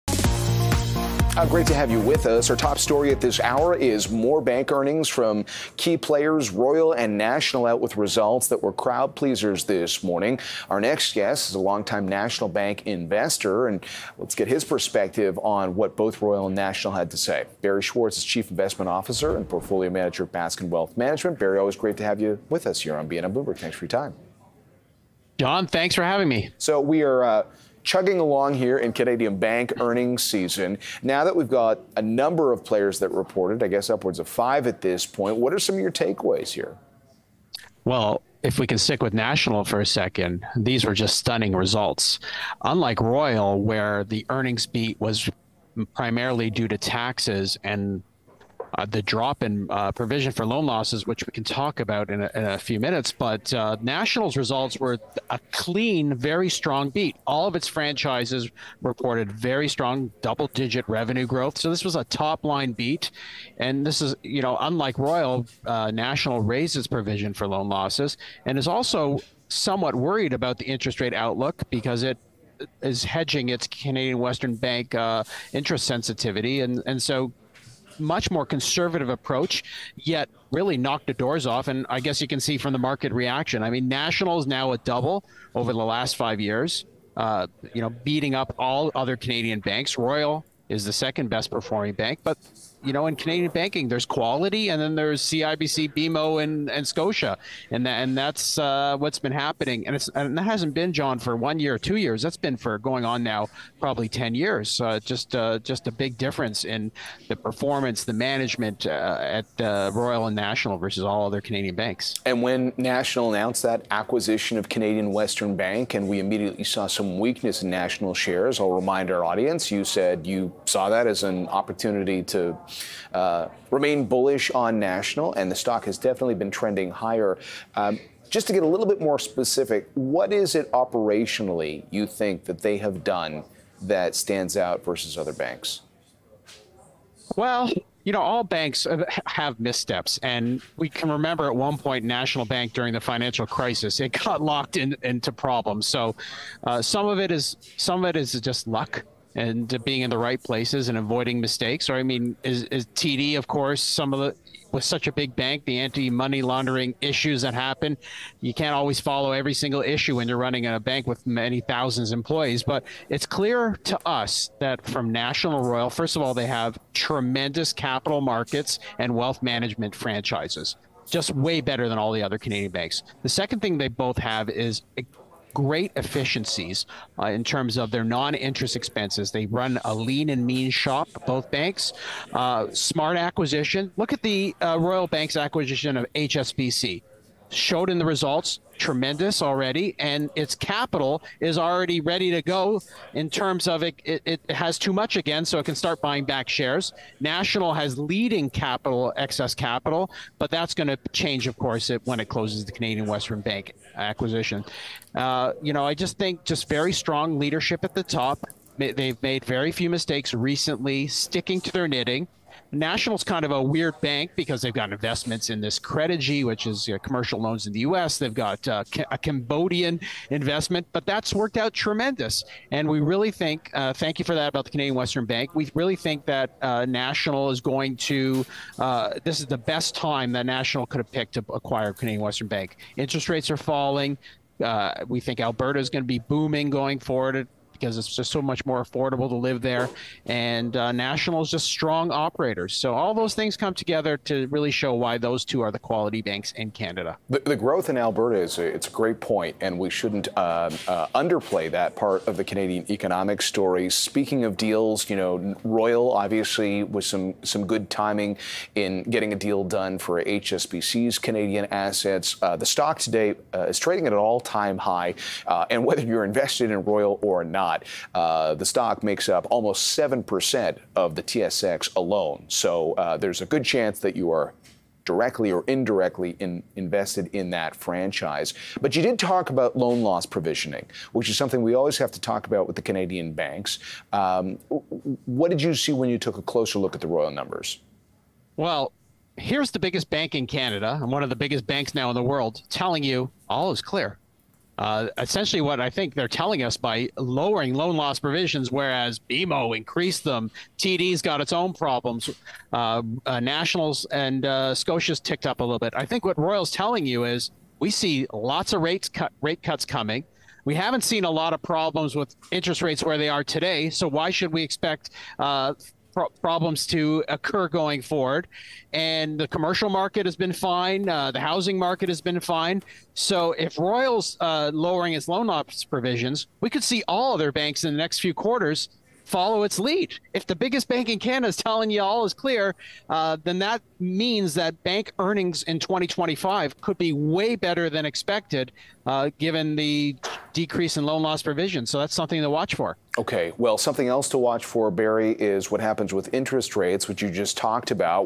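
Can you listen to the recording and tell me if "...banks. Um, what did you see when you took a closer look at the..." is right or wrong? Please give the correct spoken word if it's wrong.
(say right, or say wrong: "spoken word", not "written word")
right.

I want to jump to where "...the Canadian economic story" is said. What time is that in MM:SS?
04:12.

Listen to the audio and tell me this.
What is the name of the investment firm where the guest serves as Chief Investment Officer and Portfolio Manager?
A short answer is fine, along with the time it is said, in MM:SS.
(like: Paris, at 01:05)
Baskin Wealth Management, at 00:20.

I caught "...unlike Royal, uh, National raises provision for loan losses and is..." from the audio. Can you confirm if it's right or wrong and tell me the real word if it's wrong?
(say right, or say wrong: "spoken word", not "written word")
right.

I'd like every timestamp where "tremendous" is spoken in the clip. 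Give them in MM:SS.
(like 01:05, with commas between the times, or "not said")
02:46, 03:08, 03:41.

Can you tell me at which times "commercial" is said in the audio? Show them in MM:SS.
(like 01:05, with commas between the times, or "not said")
03:37, 05:19.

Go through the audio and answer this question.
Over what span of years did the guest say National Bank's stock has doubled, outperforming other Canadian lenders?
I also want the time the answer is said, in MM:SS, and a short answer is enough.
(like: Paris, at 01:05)
5 years, at 01:26.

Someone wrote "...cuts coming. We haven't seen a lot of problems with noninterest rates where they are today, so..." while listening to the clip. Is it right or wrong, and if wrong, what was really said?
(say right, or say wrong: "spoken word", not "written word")
wrong: "interest", not "noninterest".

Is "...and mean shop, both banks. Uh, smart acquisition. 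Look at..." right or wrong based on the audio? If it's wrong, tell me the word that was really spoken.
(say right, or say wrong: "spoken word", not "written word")
right.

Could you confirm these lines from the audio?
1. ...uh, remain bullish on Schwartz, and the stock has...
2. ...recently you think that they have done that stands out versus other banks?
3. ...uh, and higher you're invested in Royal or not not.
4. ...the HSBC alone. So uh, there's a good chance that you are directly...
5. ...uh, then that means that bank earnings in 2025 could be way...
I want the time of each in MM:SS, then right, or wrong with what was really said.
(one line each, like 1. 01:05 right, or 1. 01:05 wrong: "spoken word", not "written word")
1. 02:03 wrong: "National", not "Schwartz"
2. 02:10 wrong: "operationally", not "recently"
3. 04:25 wrong: "whether", not "higher"
4. 04:31 wrong: "TSX", not "HSBC"
5. 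05:33 right.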